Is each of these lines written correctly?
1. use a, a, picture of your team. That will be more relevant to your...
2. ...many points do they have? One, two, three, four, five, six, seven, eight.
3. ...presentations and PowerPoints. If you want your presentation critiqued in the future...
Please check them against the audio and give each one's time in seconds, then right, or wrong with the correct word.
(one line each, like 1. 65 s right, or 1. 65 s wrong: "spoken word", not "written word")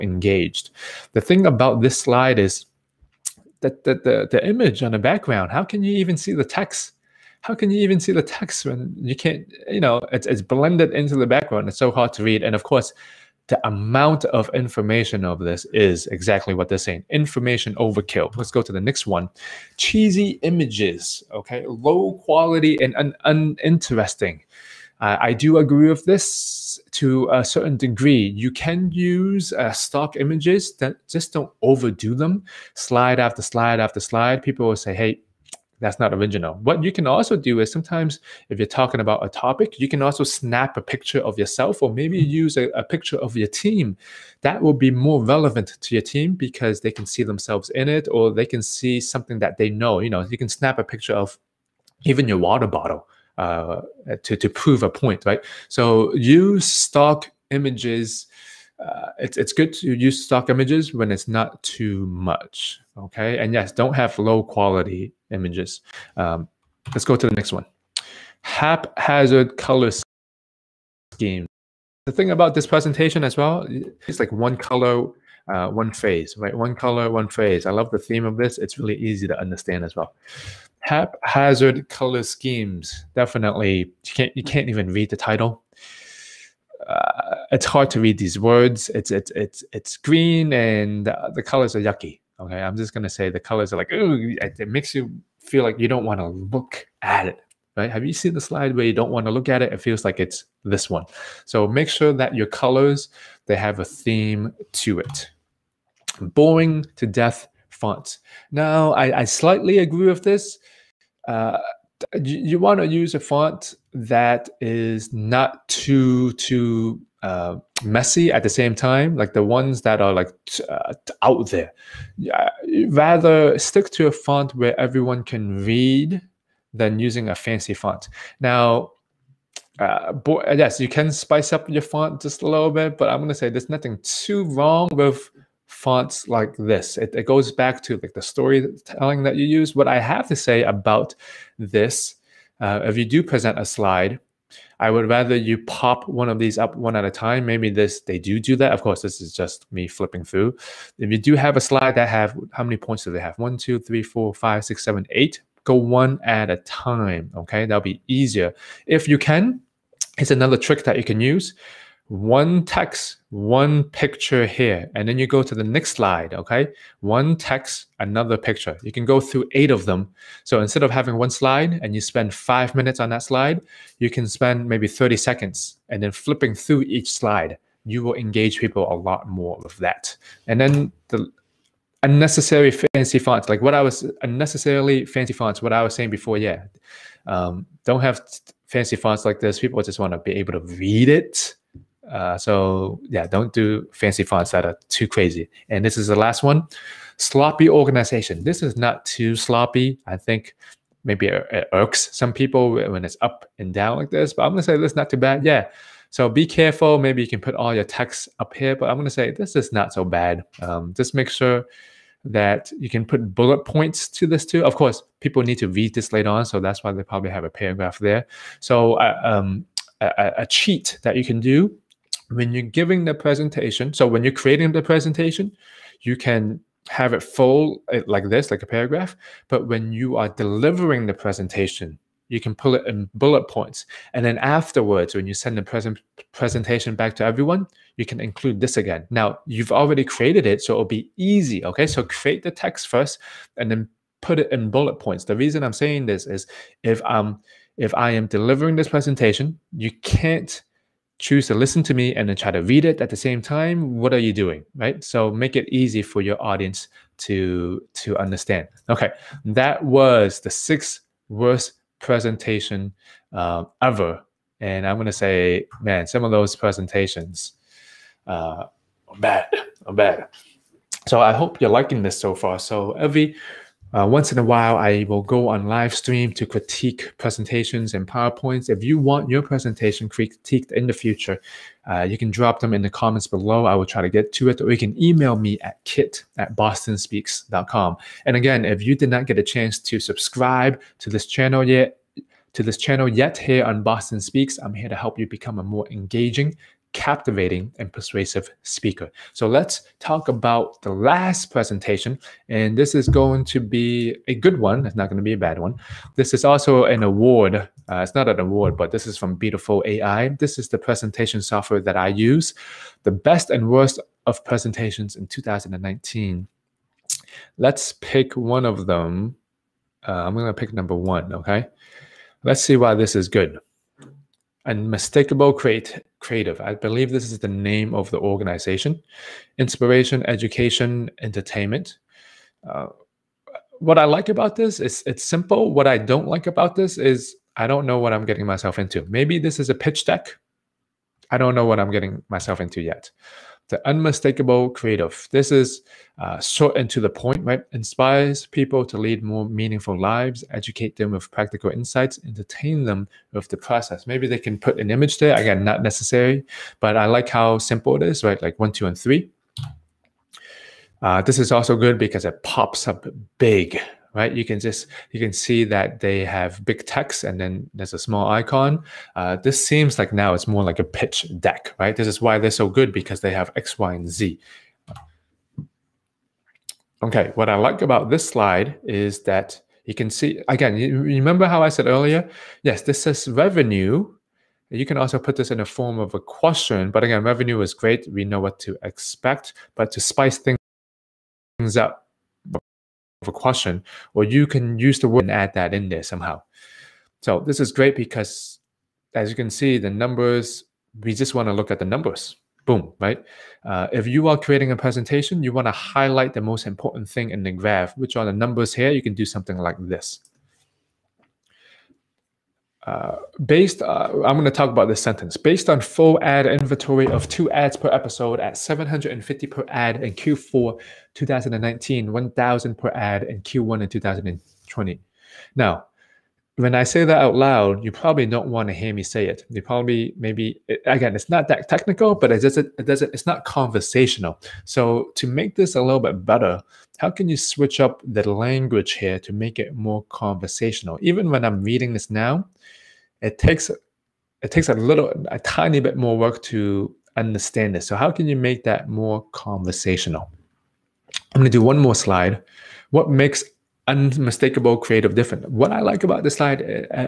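1. 42 s right
2. 152 s right
3. 277 s right.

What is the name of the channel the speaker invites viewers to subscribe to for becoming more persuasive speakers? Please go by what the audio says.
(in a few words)
Boston Speaks.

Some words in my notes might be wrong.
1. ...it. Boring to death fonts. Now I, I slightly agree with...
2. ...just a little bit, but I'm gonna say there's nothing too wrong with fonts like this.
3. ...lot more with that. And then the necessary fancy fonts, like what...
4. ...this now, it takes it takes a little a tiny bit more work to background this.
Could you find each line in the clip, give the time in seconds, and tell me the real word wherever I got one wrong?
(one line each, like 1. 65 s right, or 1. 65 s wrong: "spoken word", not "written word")
1. 104 s right
2. 132 s right
3. 178 s wrong: "unnecessary", not "necessary"
4. 441 s wrong: "understand", not "background".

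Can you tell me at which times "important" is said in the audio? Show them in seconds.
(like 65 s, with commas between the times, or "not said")
406 s.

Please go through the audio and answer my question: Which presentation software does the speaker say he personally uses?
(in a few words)
Beautiful AI.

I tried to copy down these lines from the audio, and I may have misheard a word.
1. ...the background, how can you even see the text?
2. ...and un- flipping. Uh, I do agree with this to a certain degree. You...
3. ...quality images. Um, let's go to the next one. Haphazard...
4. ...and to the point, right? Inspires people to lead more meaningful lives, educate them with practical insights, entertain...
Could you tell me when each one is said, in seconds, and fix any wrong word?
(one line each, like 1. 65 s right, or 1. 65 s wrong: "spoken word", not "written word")
1. 4 s right
2. 22 s wrong: "uninteresting", not "flipping"
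3. 64 s right
4. 346 s right.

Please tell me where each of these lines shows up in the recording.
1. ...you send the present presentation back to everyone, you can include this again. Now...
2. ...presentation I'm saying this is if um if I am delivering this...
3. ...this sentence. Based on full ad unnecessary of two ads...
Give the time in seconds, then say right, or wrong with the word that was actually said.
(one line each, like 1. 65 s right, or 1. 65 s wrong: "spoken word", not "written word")
1. 235 s right
2. 245 s wrong: "reason", not "presentation"
3. 414 s wrong: "inventory", not "unnecessary".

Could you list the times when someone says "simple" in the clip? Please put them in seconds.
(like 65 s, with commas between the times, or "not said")
335 s, 357 s.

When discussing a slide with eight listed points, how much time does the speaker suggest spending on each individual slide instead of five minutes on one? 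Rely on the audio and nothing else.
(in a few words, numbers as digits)
30 seconds.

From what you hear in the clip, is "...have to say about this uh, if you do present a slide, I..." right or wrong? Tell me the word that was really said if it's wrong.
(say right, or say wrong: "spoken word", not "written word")
right.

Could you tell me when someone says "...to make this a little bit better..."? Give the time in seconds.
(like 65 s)
435 s.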